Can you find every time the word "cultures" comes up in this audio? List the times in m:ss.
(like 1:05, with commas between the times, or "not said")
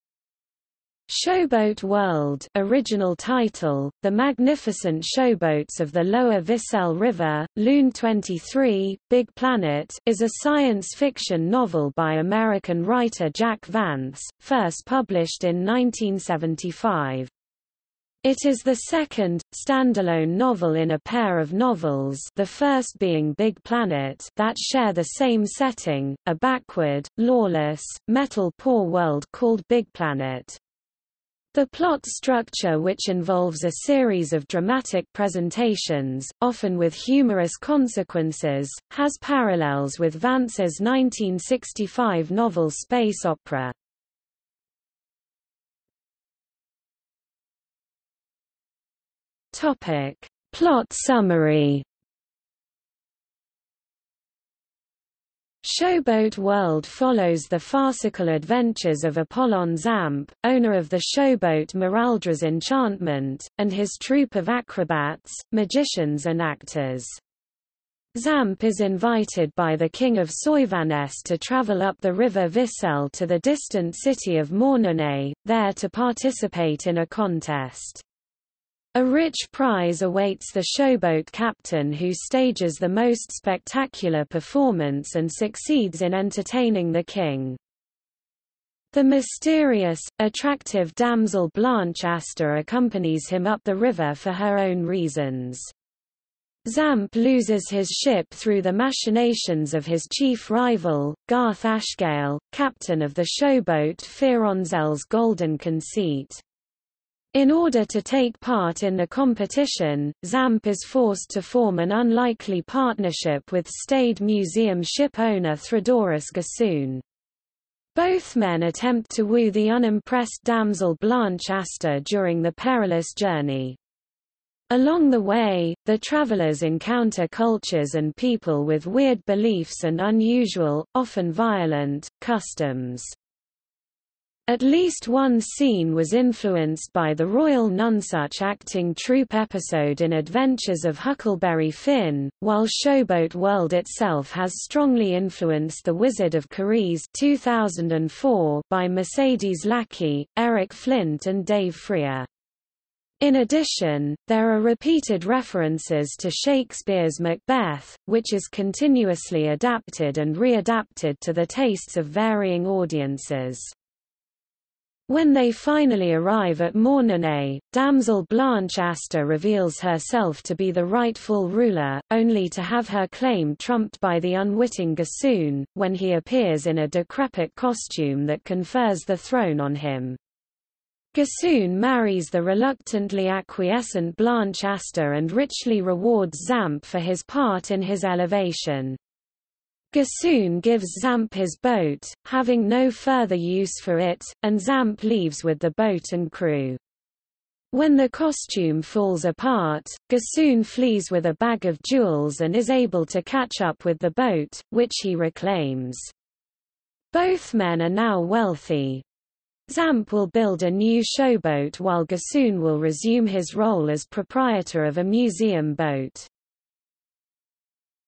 2:07.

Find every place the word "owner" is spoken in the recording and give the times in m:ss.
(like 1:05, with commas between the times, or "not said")
1:00, 1:55.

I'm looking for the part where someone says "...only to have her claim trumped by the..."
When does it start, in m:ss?
2:52.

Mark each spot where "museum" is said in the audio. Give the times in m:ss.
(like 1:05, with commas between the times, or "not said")
1:54, 3:35.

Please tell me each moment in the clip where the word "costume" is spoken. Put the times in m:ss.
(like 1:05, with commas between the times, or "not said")
2:57, 3:18.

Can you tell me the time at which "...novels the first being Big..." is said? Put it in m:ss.
0:21.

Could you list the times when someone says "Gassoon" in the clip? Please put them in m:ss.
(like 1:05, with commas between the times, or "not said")
1:56, 2:54, 3:01, 3:09, 3:20, 3:32.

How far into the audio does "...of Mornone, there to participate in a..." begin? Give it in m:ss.
1:14.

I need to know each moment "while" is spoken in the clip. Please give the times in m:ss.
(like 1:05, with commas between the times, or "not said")
2:22, 3:31.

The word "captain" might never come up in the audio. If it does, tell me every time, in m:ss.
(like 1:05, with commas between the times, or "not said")
1:21, 1:42.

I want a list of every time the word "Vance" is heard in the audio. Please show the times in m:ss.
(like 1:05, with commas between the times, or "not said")
0:13, 0:40.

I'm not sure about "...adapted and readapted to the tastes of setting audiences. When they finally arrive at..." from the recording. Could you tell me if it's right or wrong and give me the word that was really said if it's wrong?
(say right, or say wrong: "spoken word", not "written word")
wrong: "varying", not "setting".